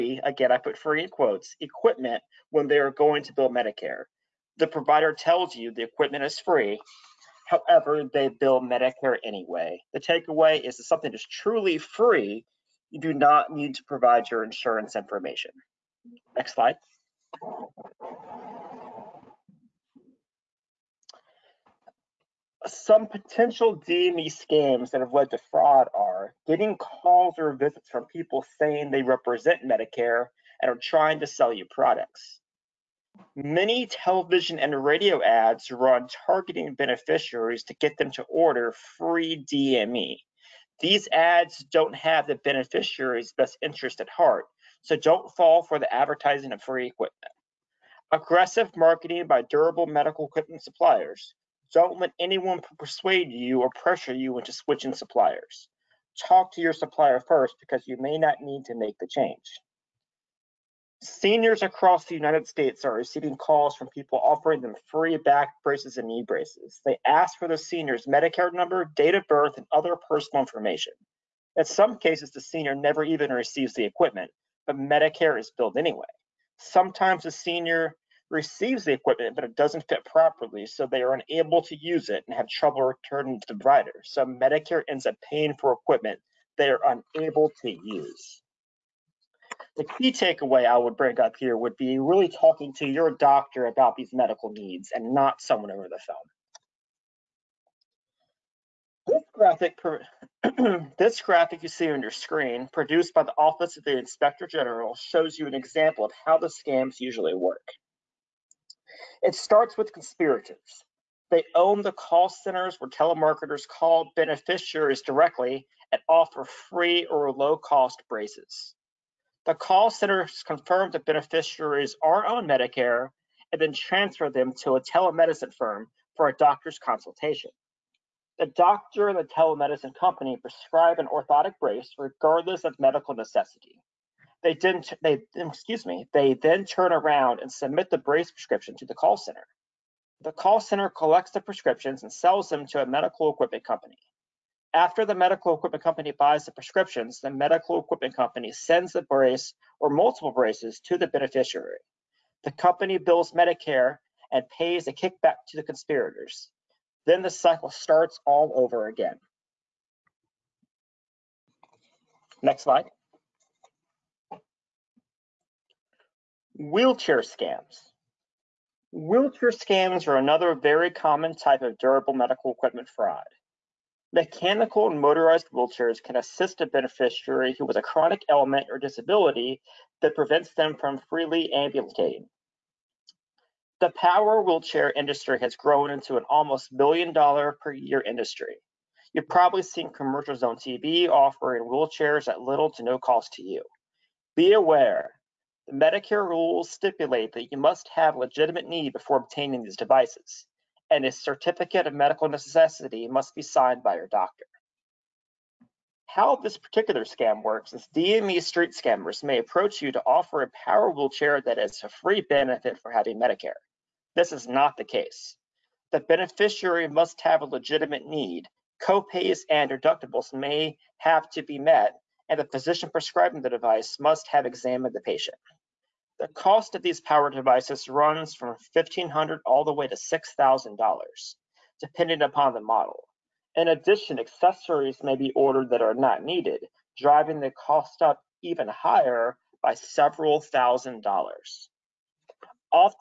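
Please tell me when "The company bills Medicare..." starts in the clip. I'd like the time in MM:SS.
02:32.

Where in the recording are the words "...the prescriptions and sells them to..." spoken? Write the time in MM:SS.
02:21.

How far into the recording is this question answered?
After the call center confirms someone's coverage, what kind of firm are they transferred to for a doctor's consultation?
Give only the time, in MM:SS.
02:04.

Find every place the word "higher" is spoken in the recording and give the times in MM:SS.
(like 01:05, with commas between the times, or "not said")
03:58.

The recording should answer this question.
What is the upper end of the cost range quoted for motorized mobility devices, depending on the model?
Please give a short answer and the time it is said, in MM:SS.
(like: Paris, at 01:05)
$6,000, at 03:49.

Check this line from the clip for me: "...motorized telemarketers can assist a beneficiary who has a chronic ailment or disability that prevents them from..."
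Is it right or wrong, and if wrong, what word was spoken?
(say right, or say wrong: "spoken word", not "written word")
wrong: "wheelchairs", not "telemarketers".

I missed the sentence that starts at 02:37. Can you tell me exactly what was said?
Then the cycle starts all over again.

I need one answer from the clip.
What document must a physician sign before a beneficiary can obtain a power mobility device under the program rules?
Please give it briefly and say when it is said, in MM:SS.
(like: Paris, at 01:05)
certificate of medical necessity, at 03:21.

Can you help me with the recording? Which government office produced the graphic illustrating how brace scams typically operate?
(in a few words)
Office of the Inspector General.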